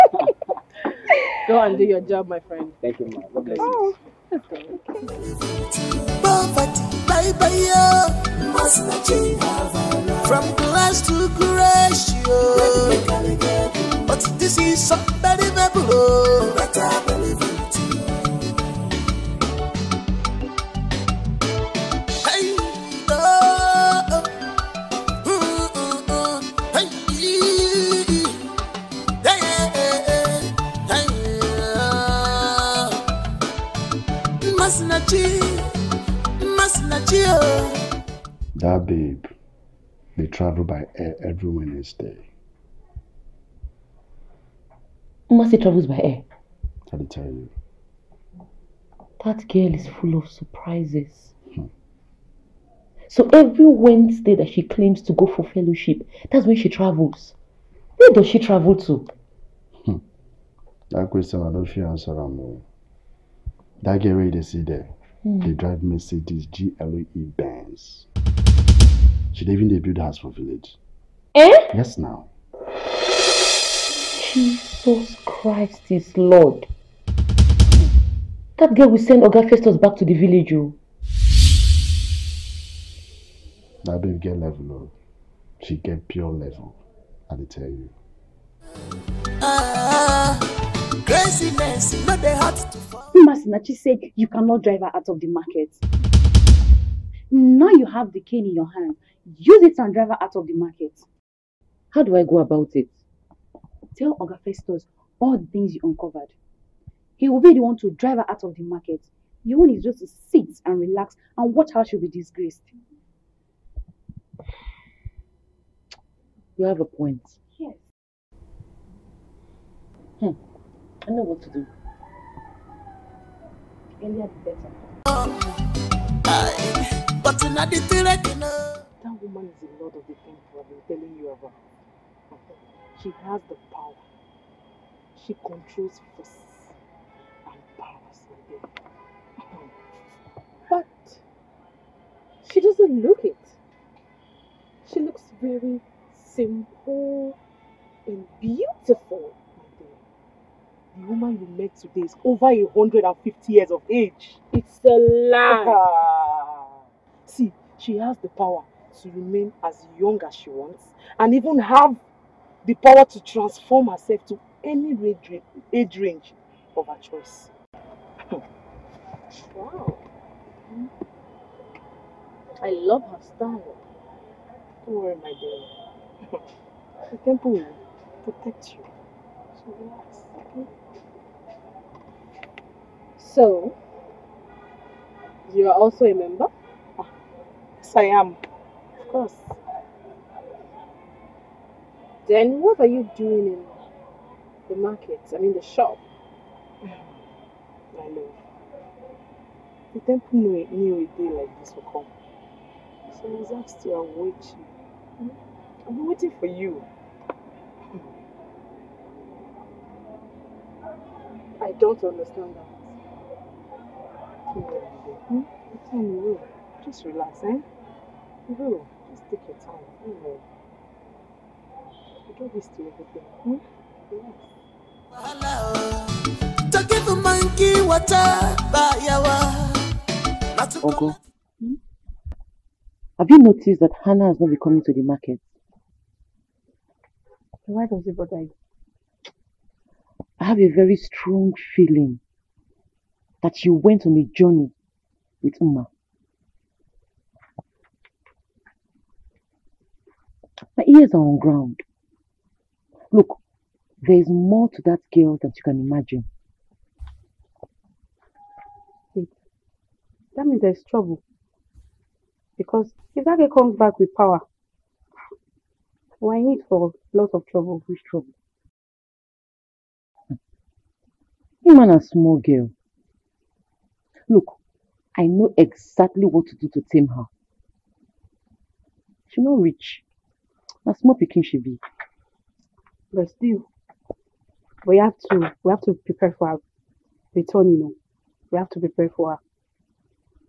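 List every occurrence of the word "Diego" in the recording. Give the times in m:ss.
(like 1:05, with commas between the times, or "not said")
not said.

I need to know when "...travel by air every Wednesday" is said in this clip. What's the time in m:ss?
0:40.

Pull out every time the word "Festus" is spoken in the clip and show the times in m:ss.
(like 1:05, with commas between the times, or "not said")
1:19, 1:44.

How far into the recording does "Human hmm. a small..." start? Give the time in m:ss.
4:31.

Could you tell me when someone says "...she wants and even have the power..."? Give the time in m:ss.
2:40.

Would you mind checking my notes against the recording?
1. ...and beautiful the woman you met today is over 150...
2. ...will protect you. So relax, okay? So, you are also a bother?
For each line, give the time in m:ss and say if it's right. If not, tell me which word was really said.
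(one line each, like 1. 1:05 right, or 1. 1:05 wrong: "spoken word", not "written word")
1. 2:28 right
2. 2:57 wrong: "member", not "bother".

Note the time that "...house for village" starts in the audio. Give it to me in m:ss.
1:09.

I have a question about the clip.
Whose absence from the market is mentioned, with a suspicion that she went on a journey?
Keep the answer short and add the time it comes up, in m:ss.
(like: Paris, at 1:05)
Hannah, at 3:54.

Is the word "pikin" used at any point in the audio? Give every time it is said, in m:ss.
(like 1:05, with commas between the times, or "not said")
4:41.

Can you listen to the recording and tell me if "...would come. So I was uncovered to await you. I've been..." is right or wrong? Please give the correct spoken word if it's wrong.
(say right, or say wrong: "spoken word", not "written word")
wrong: "asked", not "uncovered".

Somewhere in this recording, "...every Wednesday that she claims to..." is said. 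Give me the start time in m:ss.
0:53.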